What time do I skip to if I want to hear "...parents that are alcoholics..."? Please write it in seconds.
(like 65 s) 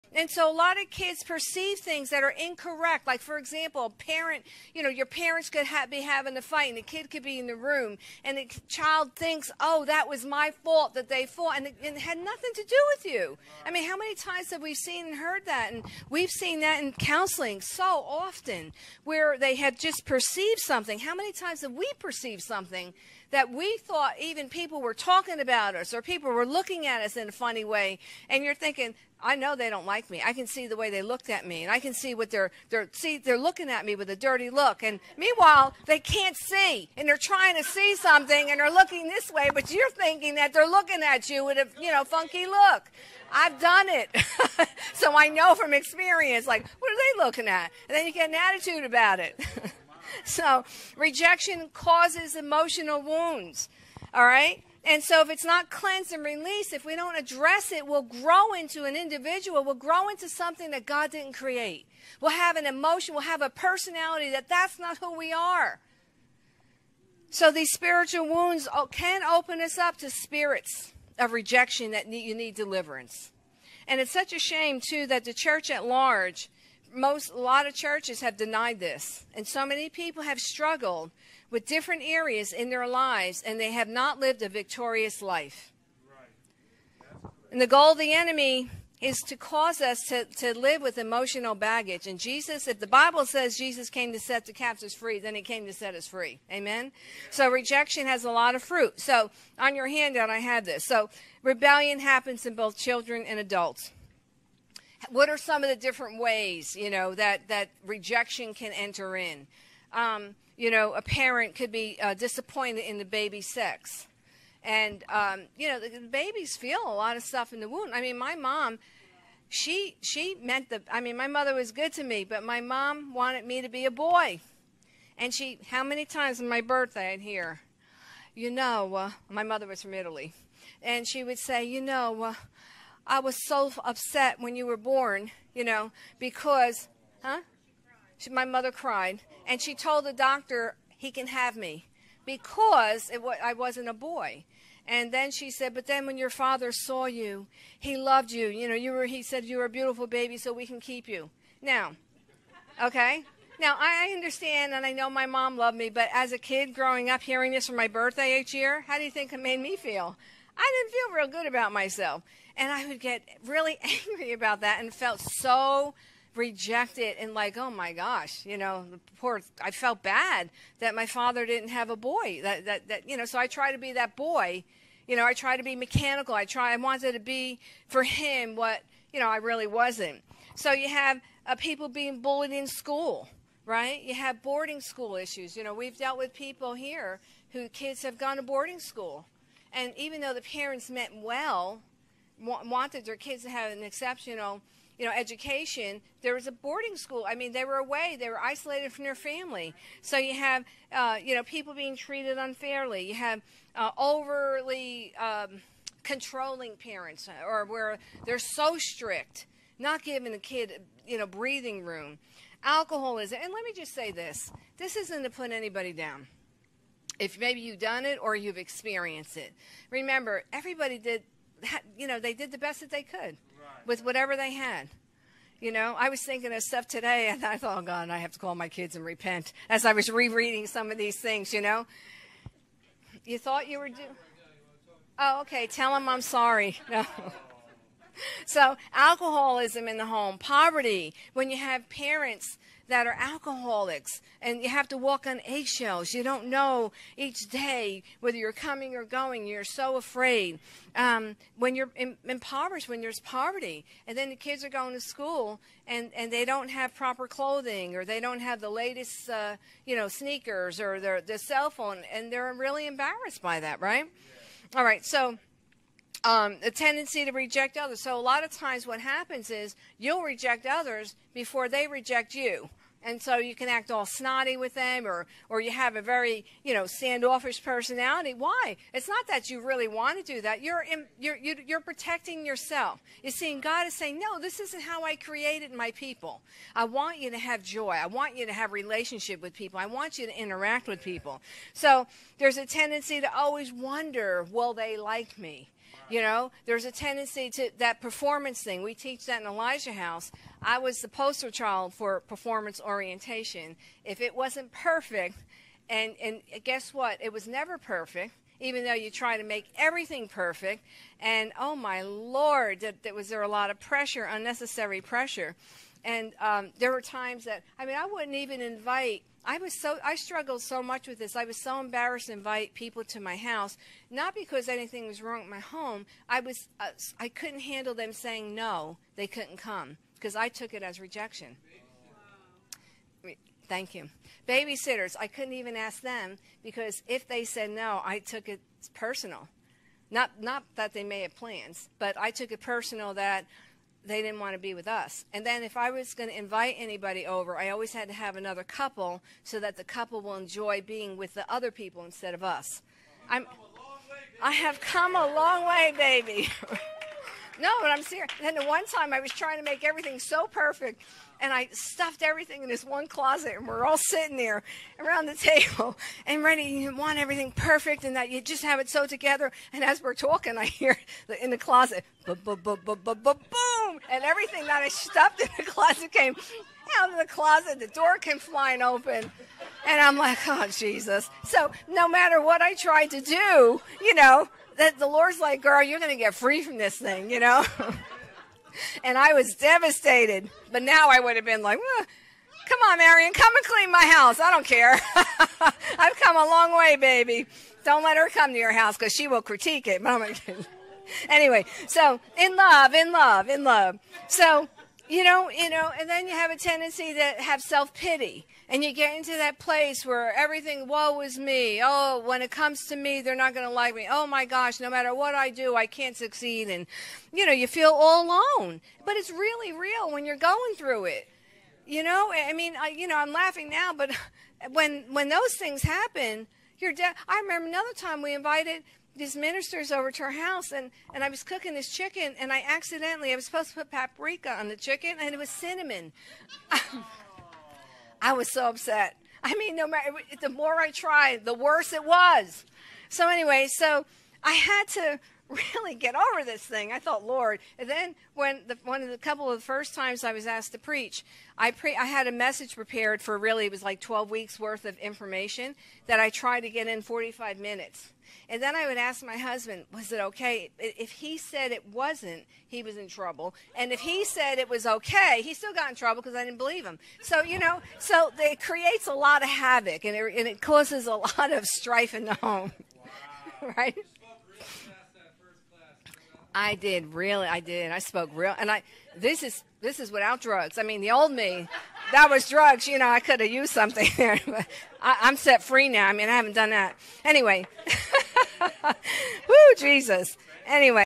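241 s.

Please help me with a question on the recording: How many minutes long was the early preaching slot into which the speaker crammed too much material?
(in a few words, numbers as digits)
45.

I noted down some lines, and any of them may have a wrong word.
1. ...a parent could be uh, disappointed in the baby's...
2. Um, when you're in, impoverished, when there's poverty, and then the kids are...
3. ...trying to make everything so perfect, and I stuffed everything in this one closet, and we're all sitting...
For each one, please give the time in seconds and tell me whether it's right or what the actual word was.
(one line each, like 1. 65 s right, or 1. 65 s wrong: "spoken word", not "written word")
1. 110 s right
2. 250 s right
3. 359 s right.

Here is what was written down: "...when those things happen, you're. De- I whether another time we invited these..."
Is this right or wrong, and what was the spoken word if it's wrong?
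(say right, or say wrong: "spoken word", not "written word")
wrong: "remember", not "whether".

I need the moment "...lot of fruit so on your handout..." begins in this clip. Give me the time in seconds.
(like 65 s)
98 s.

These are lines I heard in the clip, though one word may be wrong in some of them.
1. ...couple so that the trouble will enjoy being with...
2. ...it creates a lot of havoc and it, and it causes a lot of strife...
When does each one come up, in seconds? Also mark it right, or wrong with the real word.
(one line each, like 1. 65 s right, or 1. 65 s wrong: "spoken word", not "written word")
1. 348 s wrong: "couple", not "trouble"
2. 468 s right.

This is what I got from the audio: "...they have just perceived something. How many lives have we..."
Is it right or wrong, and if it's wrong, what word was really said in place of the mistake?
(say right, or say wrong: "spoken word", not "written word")
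wrong: "times", not "lives".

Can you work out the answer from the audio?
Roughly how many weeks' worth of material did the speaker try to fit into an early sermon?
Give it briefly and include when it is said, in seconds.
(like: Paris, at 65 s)
12, at 453 s.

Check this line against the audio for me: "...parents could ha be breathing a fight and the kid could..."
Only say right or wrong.
wrong.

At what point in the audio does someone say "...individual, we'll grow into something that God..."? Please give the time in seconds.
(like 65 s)
58 s.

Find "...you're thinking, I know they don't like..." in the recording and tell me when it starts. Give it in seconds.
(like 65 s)
28 s.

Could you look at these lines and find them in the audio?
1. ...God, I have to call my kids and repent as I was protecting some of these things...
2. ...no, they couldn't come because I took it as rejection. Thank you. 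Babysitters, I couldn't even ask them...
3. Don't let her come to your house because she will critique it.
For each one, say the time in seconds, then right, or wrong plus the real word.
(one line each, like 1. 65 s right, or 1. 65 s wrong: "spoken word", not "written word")
1. 227 s wrong: "rereading", not "protecting"
2. 328 s right
3. 397 s right.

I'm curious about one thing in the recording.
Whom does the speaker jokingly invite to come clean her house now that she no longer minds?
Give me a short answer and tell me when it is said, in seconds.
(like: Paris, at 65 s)
Marion, at 392 s.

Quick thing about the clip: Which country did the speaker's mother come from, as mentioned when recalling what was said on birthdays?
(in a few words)
Italy.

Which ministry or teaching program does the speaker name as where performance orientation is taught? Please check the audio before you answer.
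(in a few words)
Elijah House.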